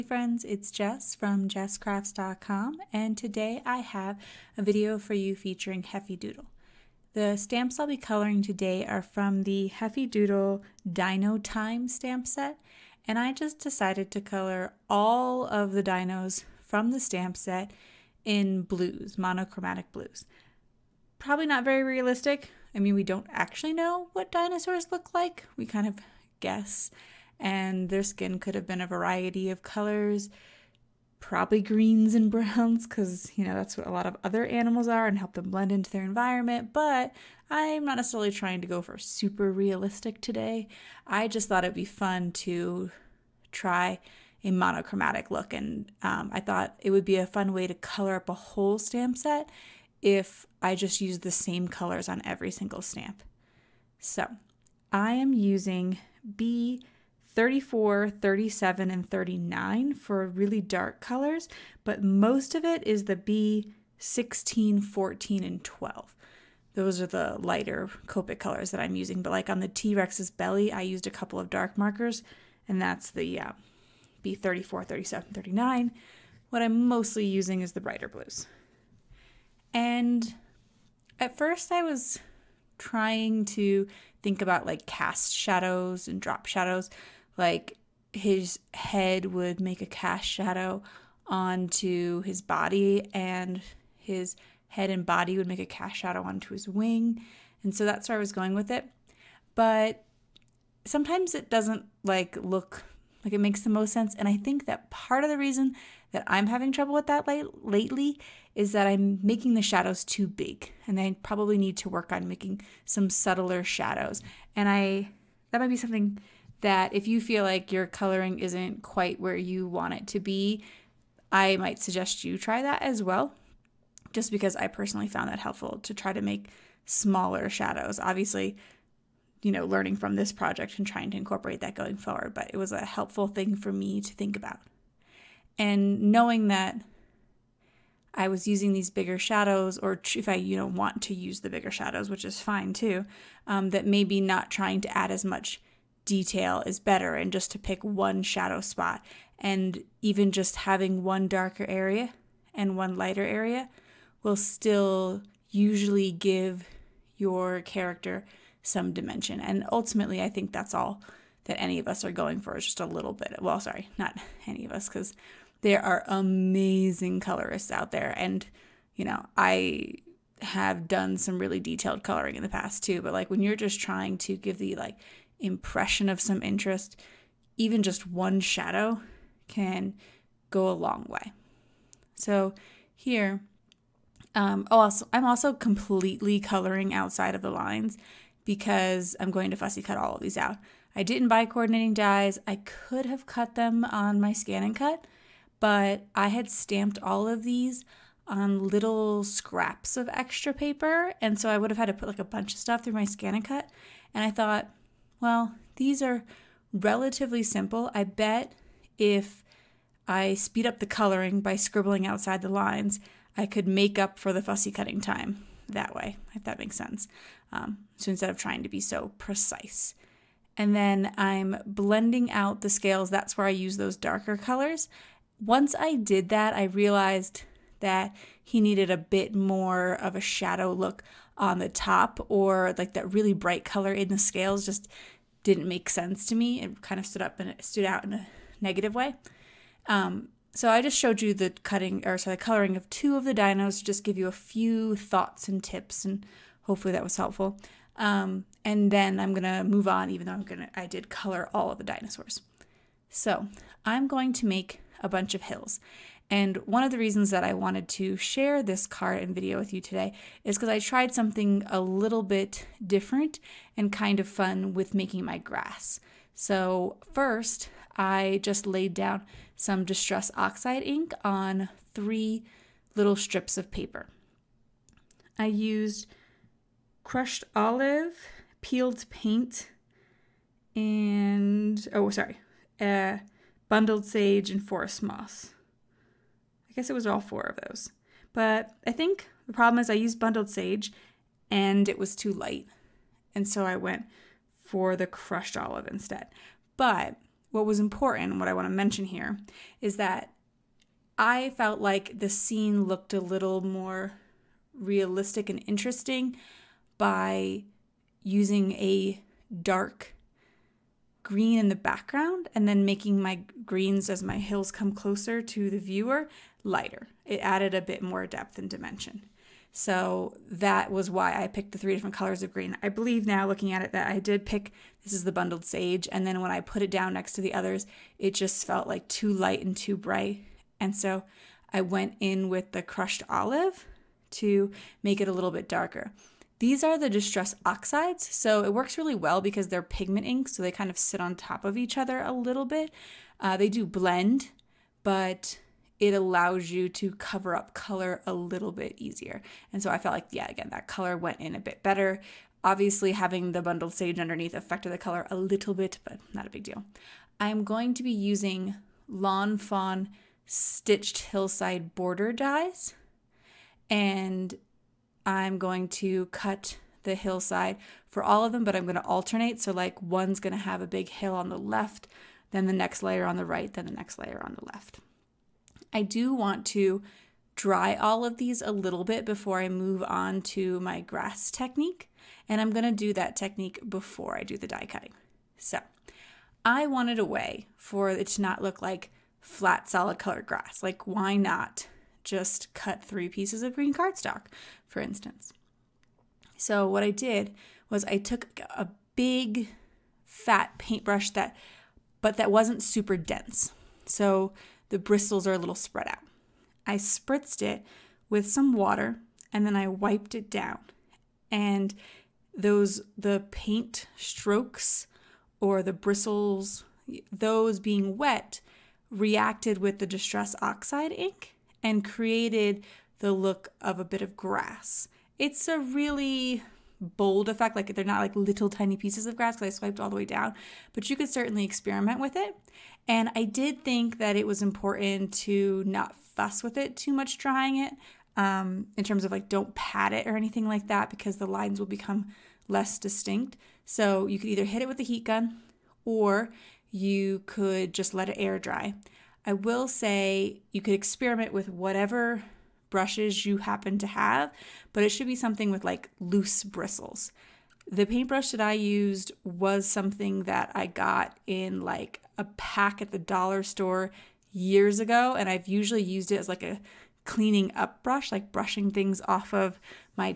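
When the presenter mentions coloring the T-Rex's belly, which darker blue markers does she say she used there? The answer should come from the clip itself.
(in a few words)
B34, 37, 39.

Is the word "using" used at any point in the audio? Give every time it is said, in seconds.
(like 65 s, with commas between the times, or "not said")
55 s, 68 s, 77 s, 138 s, 308 s, 358 s.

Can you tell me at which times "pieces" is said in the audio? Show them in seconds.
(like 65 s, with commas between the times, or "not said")
393 s, 428 s.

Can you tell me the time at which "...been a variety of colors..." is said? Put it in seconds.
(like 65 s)
28 s.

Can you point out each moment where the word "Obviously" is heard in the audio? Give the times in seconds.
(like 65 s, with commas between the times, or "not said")
127 s, 352 s.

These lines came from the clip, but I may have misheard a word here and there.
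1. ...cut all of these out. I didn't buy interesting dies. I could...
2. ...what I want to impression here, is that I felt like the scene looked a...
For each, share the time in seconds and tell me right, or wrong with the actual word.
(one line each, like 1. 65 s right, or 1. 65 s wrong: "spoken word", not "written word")
1. 189 s wrong: "coordinating", not "interesting"
2. 298 s wrong: "mention", not "impression".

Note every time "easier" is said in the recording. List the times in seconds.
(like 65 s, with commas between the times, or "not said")
348 s.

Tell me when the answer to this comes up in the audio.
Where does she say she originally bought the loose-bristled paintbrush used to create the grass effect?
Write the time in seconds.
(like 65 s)
463 s.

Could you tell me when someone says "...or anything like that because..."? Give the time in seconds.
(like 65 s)
440 s.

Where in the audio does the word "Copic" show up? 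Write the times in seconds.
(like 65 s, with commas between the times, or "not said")
68 s.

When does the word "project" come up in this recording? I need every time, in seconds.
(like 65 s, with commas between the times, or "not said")
130 s.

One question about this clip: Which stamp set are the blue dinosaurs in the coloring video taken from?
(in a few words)
Dino Time.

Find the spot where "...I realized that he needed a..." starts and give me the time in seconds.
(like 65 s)
226 s.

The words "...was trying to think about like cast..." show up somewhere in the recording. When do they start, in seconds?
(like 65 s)
81 s.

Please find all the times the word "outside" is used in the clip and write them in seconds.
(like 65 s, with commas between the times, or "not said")
186 s, 212 s.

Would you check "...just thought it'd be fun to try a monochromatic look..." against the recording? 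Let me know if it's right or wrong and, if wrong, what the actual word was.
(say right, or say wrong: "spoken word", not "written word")
right.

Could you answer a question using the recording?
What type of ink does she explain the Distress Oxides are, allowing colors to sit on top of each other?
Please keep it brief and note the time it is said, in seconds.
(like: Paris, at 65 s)
Pigment inks, at 339 s.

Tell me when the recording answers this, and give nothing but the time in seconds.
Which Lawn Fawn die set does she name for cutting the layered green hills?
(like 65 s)
360 s.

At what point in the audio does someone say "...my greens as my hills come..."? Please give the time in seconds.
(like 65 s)
313 s.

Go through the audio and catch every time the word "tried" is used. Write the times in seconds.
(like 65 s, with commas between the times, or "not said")
260 s.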